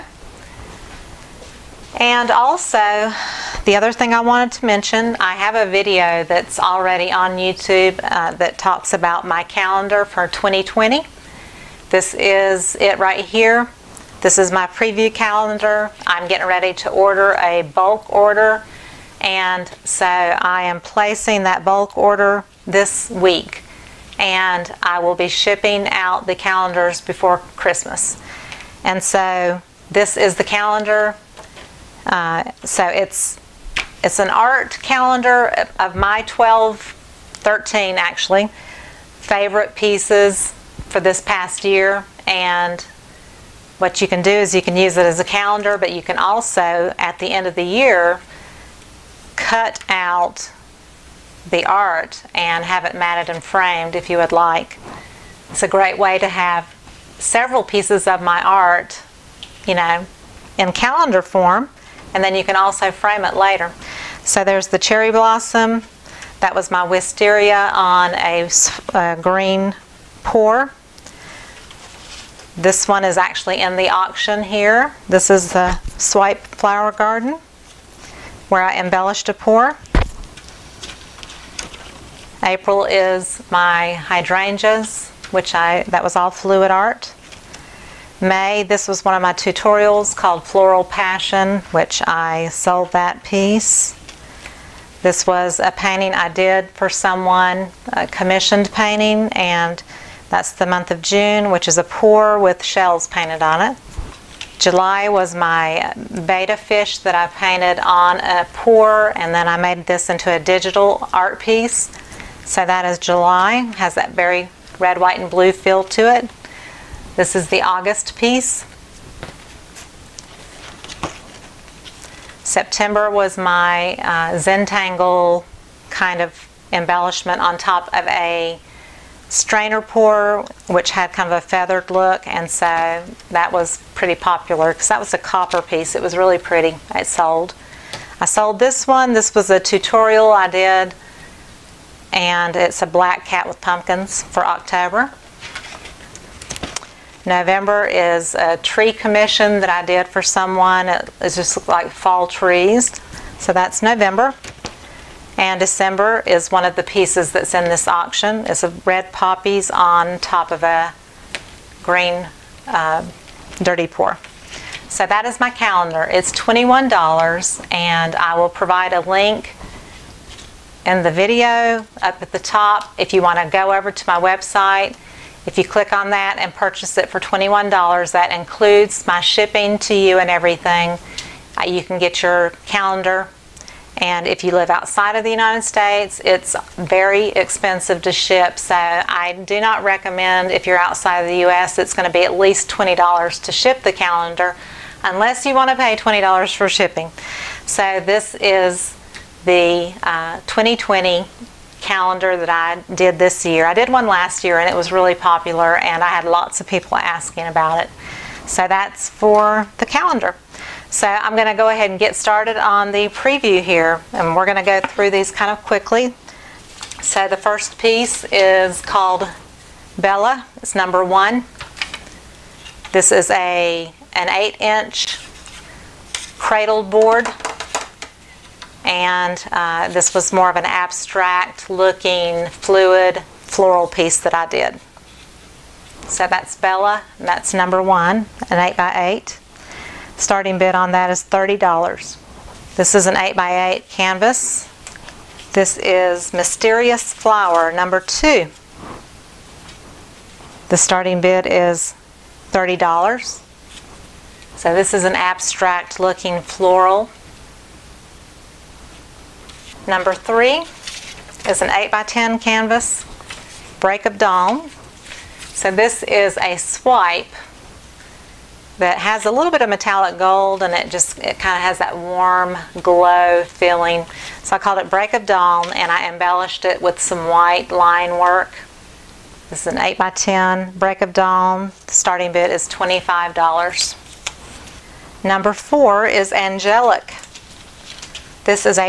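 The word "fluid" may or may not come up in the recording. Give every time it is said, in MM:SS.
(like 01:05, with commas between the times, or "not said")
01:26, 03:52.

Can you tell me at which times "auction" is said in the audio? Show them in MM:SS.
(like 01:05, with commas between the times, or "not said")
01:13, 02:37.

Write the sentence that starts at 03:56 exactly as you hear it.
So that's Bella, and that's number one, an 8x8.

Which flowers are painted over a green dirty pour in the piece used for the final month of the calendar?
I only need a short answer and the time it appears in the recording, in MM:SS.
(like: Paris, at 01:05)
red poppies, at 02:38.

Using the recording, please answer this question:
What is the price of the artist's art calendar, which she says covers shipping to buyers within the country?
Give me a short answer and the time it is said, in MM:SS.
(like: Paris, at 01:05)
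$21, at 02:46.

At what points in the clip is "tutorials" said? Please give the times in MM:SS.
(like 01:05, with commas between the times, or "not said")
01:29, 02:19.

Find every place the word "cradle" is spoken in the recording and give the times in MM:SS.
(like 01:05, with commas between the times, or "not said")
03:46.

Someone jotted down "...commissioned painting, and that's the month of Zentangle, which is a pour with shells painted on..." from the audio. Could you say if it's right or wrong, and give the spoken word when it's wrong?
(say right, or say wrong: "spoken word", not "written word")
wrong: "June", not "Zentangle".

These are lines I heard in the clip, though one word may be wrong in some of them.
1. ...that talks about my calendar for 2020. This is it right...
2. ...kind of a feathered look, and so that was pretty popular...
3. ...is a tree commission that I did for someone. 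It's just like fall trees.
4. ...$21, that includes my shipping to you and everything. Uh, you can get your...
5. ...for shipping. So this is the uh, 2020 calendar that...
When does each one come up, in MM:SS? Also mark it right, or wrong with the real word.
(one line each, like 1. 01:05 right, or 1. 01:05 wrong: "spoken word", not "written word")
1. 00:08 right
2. 02:11 right
3. 02:27 right
4. 02:57 right
5. 03:16 right.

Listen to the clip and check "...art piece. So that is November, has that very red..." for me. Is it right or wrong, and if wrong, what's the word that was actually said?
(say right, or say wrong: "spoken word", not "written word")
wrong: "July", not "November".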